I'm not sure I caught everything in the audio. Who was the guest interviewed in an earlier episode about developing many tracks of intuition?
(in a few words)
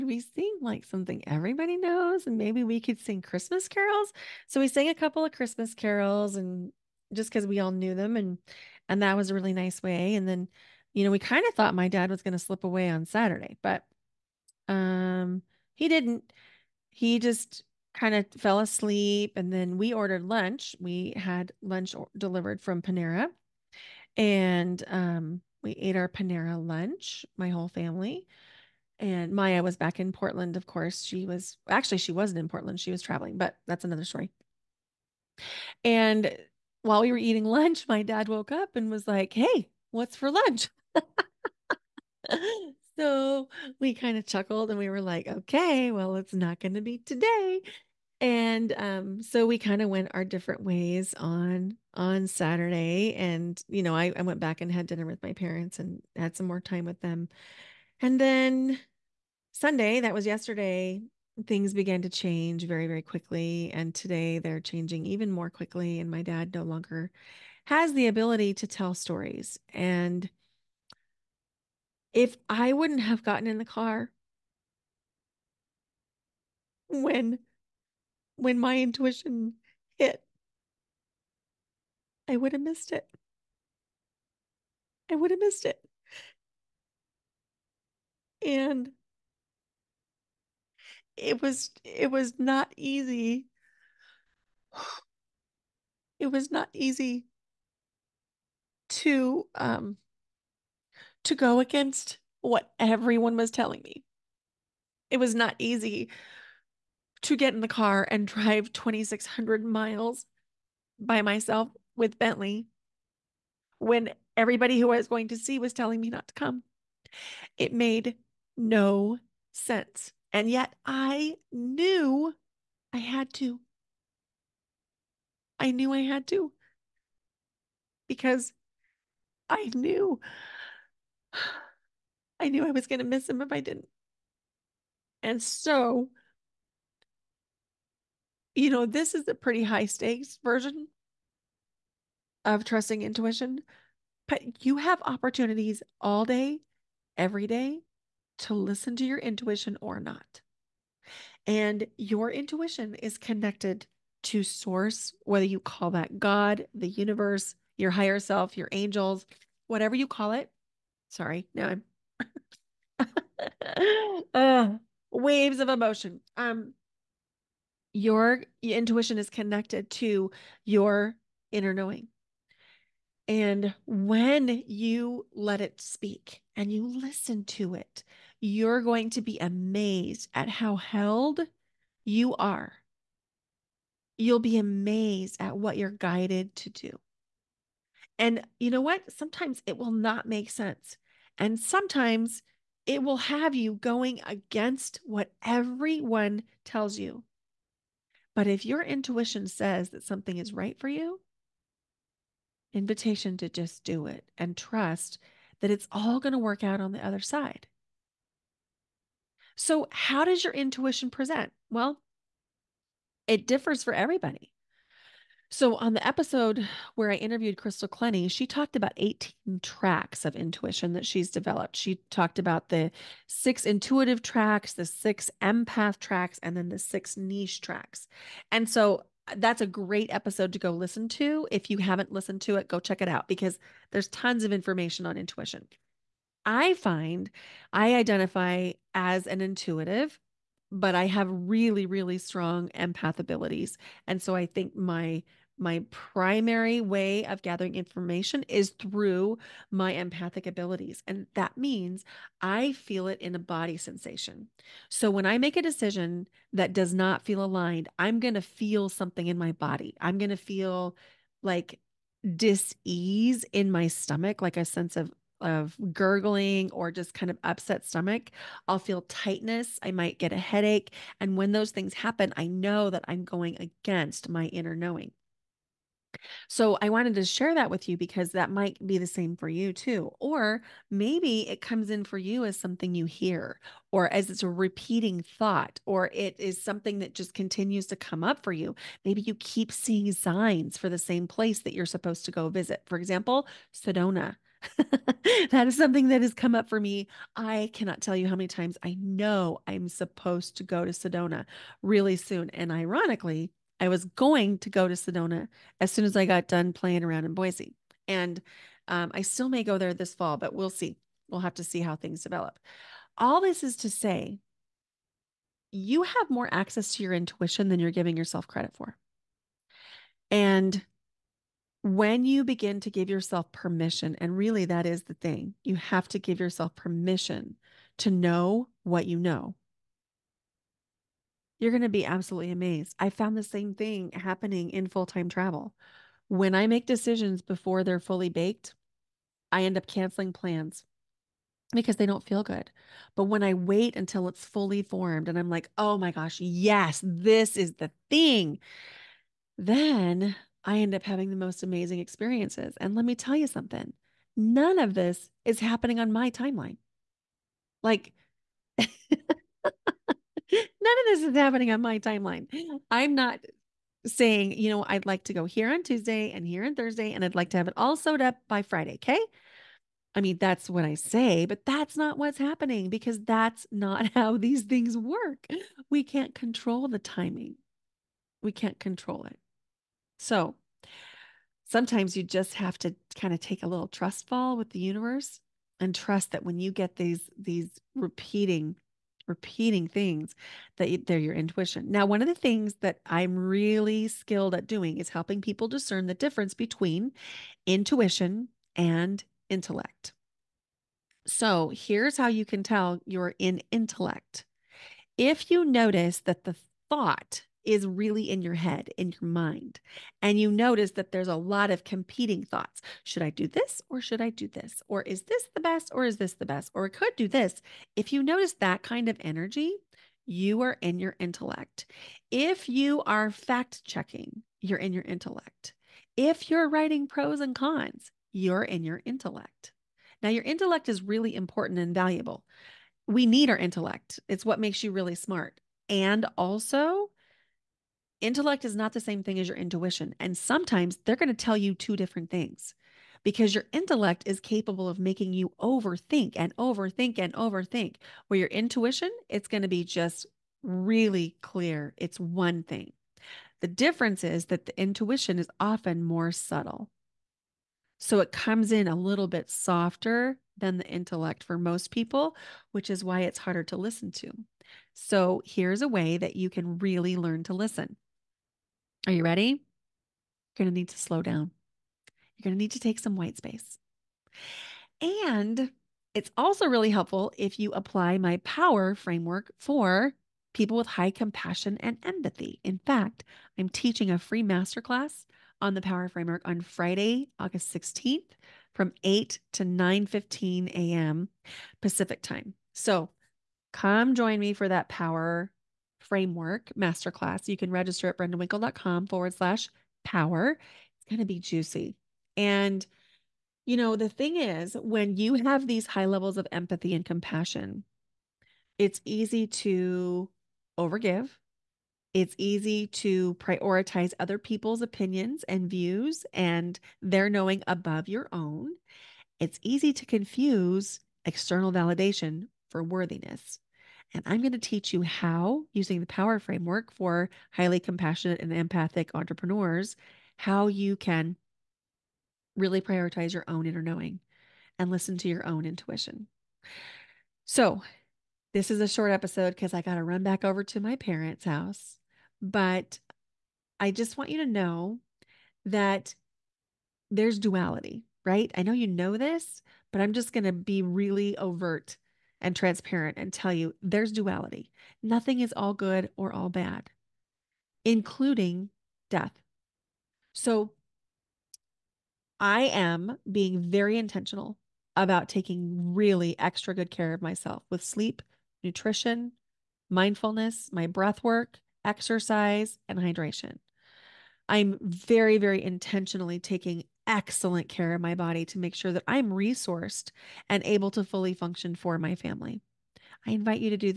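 Crystal Clenny.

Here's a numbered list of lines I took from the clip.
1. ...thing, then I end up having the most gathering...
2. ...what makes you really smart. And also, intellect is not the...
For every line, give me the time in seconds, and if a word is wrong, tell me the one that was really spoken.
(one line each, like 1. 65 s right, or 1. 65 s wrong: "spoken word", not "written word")
1. 348 s wrong: "amazing", not "gathering"
2. 434 s right.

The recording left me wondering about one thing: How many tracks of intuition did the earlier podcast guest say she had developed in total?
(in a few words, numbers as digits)
18.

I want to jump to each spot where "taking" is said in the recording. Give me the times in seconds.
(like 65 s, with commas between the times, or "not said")
565 s, 576 s.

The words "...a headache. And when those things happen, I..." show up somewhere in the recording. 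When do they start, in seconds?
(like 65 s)
270 s.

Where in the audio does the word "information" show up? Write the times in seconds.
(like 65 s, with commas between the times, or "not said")
234 s, 247 s.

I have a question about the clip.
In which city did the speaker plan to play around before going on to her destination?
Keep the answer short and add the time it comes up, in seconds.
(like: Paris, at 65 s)
Boise, at 307 s.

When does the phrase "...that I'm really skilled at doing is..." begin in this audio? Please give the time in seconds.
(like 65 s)
392 s.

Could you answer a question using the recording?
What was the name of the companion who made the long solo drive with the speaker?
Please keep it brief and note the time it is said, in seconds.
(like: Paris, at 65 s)
Bentley, at 112 s.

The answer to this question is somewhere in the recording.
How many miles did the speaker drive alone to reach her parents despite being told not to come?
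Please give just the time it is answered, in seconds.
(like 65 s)
108 s.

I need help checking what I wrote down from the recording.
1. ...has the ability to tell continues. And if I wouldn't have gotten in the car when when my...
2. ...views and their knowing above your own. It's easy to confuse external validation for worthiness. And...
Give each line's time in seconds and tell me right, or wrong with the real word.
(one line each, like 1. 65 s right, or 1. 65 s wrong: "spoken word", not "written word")
1. 67 s wrong: "stories", not "continues"
2. 515 s right.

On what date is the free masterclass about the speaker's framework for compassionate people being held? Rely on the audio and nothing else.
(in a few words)
Friday, August 16th.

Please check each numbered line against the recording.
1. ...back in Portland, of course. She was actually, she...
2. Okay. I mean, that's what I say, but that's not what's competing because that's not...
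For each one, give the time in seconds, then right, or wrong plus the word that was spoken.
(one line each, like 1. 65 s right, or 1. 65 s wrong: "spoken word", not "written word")
1. 29 s right
2. 368 s wrong: "happening", not "competing".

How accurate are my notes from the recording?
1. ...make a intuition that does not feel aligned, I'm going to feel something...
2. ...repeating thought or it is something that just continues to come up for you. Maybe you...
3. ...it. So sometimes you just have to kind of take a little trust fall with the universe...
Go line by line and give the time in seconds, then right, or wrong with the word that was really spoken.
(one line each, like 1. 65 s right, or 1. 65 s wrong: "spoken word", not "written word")
1. 255 s wrong: "decision", not "intuition"
2. 284 s right
3. 379 s right.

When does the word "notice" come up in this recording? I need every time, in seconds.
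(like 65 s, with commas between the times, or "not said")
405 s, 410 s, 418 s.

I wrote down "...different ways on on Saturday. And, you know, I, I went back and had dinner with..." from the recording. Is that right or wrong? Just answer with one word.
right.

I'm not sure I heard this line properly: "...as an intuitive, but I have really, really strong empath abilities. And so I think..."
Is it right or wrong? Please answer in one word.
right.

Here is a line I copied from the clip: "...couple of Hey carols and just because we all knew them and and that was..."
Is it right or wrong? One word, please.
wrong.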